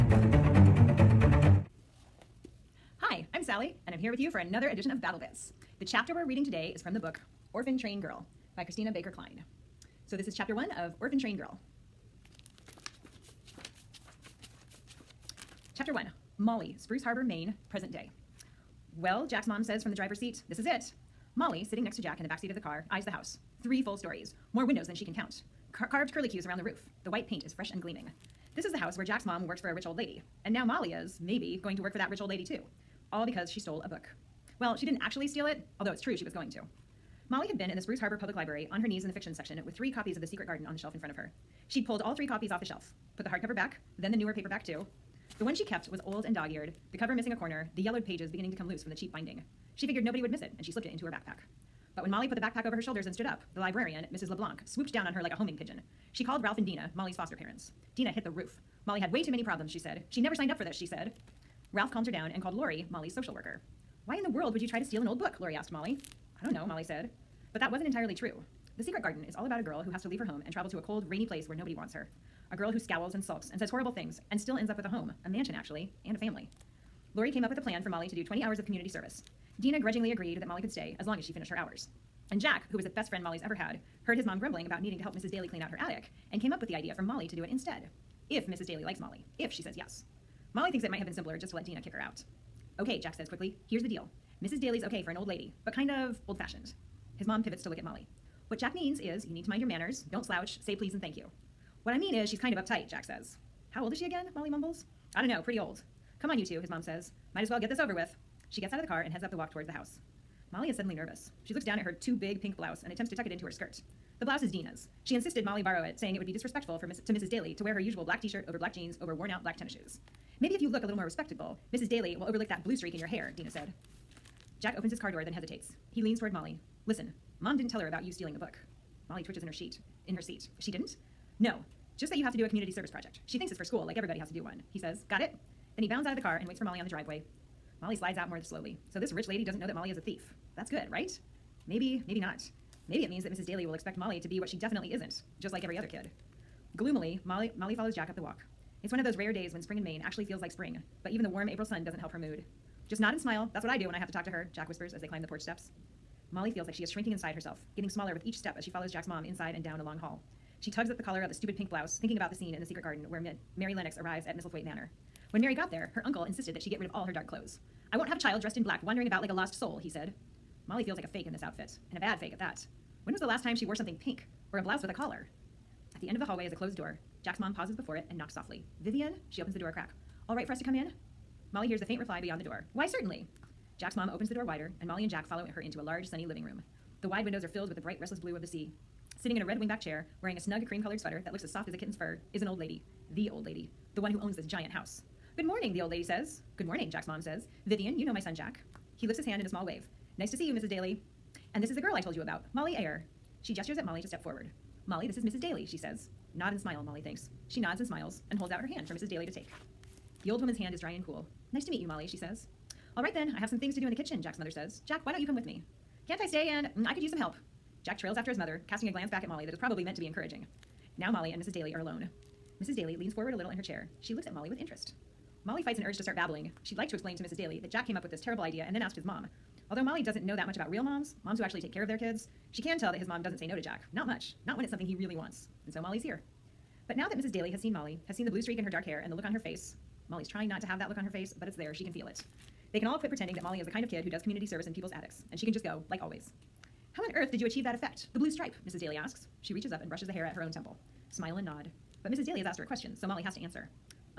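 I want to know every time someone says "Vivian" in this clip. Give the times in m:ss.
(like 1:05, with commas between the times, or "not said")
2:58, 3:17.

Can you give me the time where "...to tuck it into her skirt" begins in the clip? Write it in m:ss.
1:53.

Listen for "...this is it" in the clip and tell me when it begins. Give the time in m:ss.
0:20.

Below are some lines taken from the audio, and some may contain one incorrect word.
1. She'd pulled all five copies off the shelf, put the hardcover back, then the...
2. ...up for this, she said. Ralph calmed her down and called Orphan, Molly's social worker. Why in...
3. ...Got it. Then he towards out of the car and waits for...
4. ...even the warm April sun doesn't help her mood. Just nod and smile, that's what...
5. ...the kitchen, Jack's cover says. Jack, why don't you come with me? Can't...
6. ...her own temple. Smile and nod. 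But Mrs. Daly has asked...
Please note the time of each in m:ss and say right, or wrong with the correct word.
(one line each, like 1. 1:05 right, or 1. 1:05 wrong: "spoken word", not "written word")
1. 0:41 wrong: "three", not "five"
2. 1:00 wrong: "Lori", not "Orphan"
3. 2:15 wrong: "bounds", not "towards"
4. 2:31 right
5. 3:33 wrong: "mother", not "cover"
6. 4:10 right.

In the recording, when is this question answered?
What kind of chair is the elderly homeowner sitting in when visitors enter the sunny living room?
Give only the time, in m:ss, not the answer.
3:09.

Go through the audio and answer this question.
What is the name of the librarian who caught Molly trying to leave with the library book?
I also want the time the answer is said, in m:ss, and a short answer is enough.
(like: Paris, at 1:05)
Mrs. LeBlanc, at 0:54.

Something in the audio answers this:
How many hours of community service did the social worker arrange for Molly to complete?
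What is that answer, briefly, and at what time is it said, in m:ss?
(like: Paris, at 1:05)
20, at 1:18.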